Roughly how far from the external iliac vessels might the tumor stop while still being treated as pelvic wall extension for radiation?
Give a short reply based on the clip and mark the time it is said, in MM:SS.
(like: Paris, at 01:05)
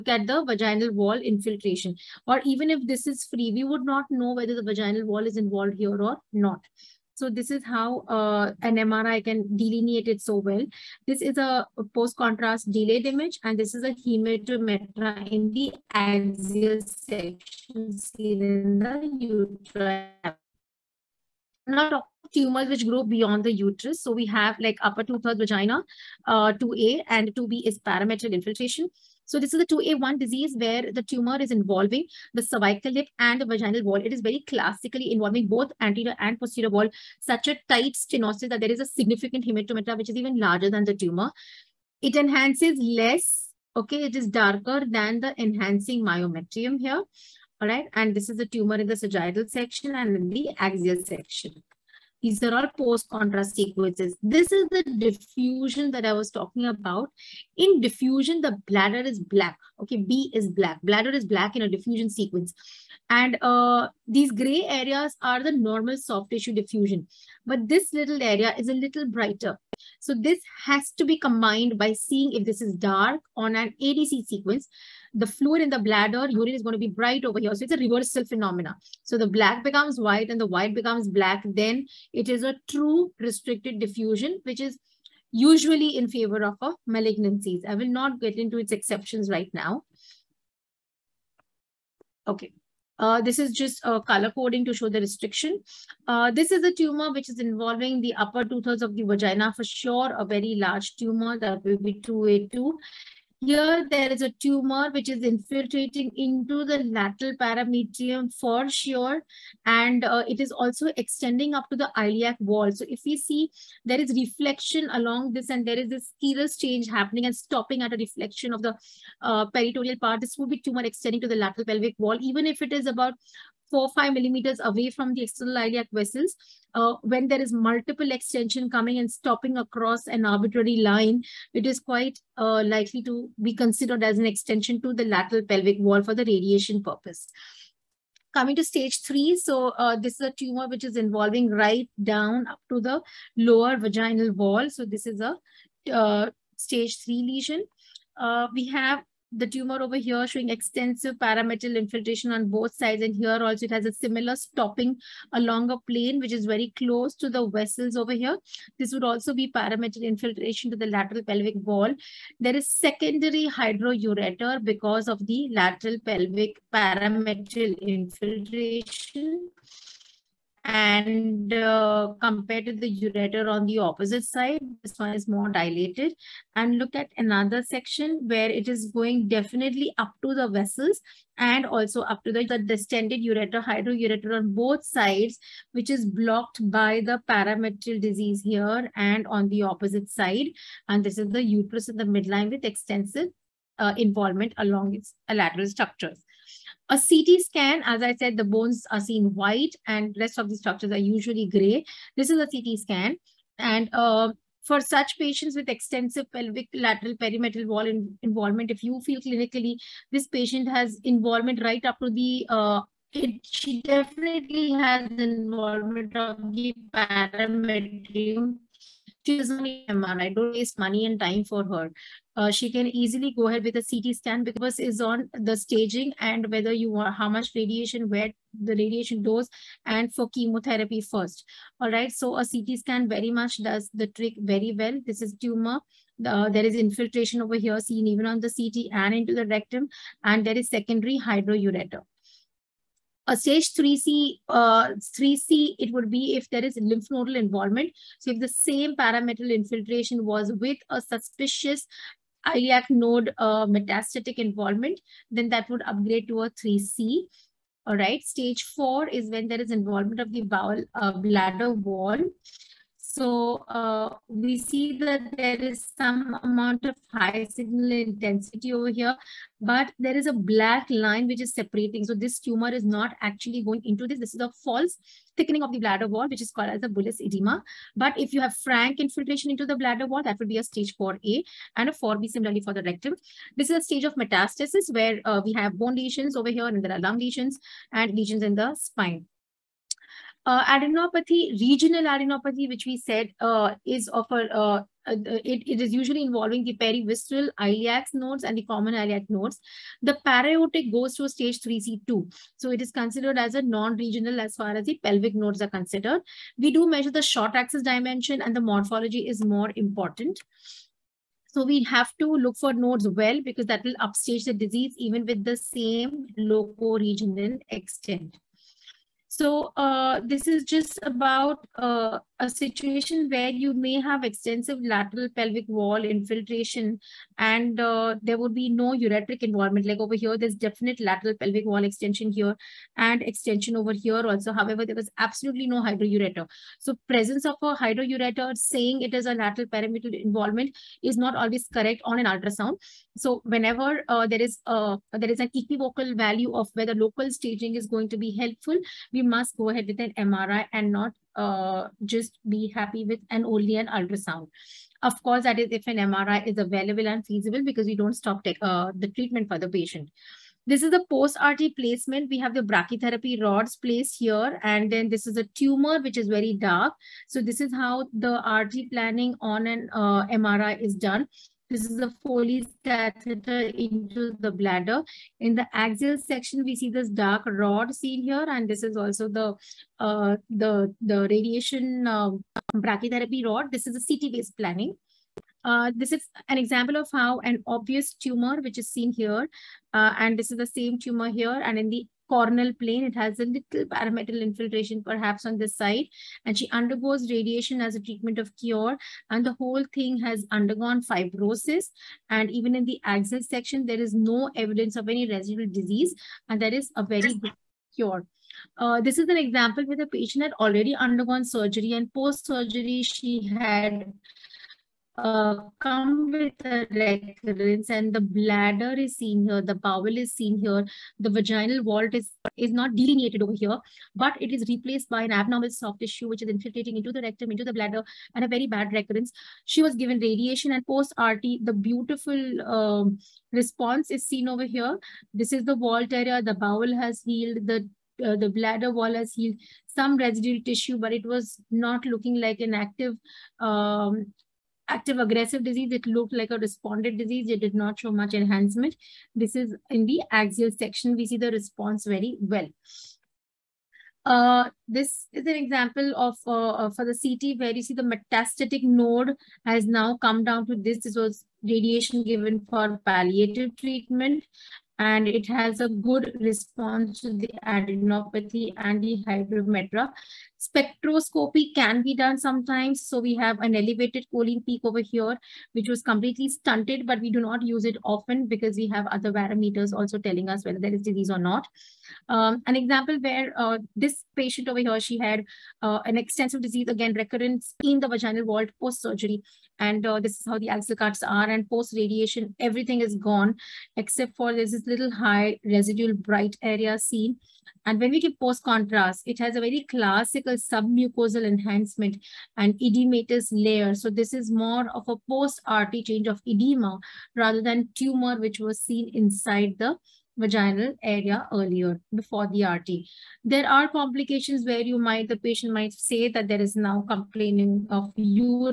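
4 to 5 millimeters, at 02:03.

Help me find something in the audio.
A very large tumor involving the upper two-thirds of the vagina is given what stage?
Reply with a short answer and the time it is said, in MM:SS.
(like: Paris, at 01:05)
2A2, at 01:42.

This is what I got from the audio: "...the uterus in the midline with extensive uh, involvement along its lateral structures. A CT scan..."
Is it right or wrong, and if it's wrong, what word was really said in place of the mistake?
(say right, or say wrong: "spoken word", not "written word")
right.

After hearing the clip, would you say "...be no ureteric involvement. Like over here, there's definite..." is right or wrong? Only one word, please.
right.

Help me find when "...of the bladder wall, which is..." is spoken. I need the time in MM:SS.
04:35.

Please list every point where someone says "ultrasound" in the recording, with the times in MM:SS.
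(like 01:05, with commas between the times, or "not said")
05:42, 05:53.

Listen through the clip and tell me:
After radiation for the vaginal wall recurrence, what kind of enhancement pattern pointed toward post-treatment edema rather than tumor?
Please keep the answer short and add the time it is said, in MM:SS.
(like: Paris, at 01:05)
Submucosal enhancement, at 08:20.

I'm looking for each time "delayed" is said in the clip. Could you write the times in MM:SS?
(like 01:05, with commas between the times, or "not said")
00:12.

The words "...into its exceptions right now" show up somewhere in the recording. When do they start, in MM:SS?
01:28.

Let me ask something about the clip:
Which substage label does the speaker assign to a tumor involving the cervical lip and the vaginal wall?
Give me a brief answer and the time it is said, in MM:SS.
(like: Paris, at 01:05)
2A1, at 00:29.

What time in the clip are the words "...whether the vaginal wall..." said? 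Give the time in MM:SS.
00:04.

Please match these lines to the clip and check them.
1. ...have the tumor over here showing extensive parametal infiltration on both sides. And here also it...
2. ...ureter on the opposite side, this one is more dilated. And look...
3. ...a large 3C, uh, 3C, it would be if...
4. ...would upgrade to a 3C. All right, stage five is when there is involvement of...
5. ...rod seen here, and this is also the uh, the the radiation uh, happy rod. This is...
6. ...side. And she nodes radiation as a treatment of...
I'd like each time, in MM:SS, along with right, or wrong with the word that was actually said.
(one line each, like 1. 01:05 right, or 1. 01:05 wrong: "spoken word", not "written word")
1. 02:28 right
2. 02:53 right
3. 04:03 wrong: "stage", not "large"
4. 04:15 wrong: "four", not "five"
5. 06:17 wrong: "brachytherapy", not "happy"
6. 06:35 wrong: "undergoes", not "nodes".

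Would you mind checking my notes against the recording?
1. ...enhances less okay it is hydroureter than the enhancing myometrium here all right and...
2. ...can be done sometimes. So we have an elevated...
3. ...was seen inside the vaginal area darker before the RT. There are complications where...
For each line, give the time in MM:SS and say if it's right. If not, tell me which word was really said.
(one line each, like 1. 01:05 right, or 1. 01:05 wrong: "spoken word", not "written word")
1. 00:42 wrong: "darker", not "hydroureter"
2. 07:51 right
3. 08:28 wrong: "earlier", not "darker".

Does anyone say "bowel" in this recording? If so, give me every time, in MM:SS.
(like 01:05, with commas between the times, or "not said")
04:20, 06:59, 07:16.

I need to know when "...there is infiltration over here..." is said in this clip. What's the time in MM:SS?
03:56.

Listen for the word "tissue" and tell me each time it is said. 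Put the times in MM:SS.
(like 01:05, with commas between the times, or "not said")
01:06, 07:05, 07:20.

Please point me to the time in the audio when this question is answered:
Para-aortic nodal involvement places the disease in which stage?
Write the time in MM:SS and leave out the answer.
05:01.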